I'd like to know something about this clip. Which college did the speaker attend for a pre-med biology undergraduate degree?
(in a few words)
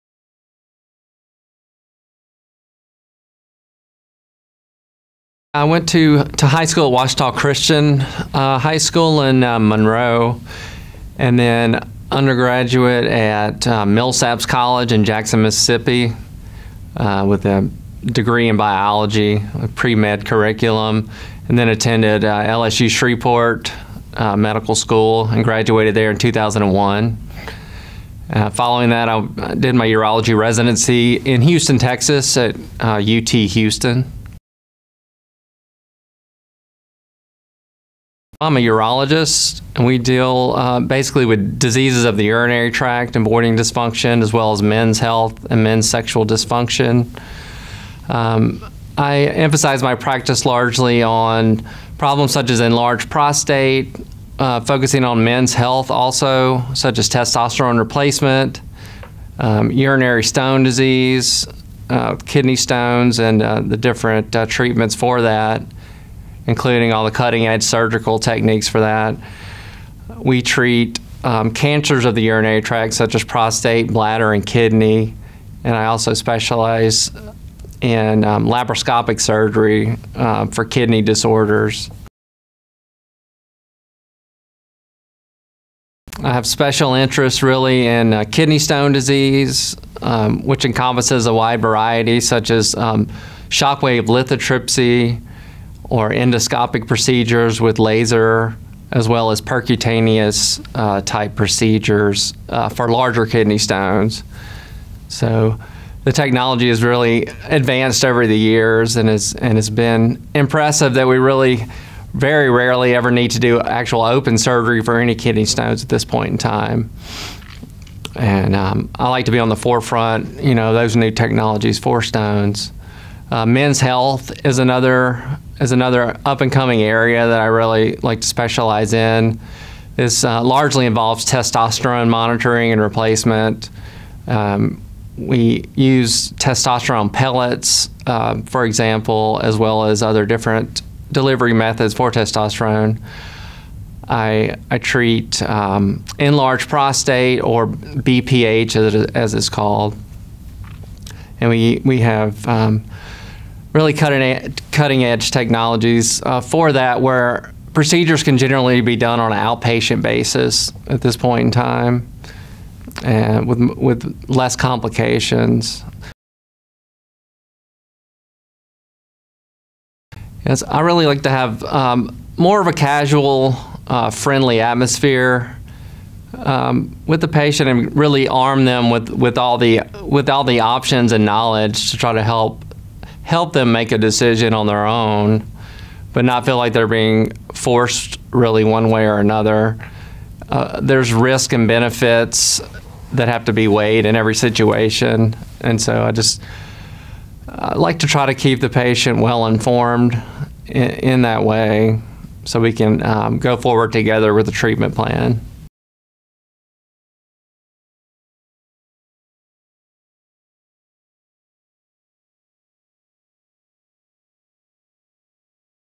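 Millsaps College.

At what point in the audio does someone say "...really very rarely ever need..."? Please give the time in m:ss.
1:51.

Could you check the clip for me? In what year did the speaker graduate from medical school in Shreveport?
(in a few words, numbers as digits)
2001.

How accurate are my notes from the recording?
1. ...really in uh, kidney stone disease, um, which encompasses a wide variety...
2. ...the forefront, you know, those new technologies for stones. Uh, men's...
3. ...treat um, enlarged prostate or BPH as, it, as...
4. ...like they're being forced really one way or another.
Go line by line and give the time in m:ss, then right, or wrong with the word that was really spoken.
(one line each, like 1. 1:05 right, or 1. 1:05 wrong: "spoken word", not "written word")
1. 1:27 right
2. 1:59 right
3. 2:24 right
4. 3:06 right.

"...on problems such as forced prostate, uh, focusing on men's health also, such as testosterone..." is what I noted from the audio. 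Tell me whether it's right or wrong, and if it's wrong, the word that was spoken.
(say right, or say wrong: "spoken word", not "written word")
wrong: "enlarged", not "forced".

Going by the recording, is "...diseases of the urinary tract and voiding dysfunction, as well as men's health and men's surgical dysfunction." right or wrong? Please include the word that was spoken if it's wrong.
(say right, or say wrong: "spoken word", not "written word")
wrong: "sexual", not "surgical".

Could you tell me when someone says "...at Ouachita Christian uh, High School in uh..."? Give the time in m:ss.
0:06.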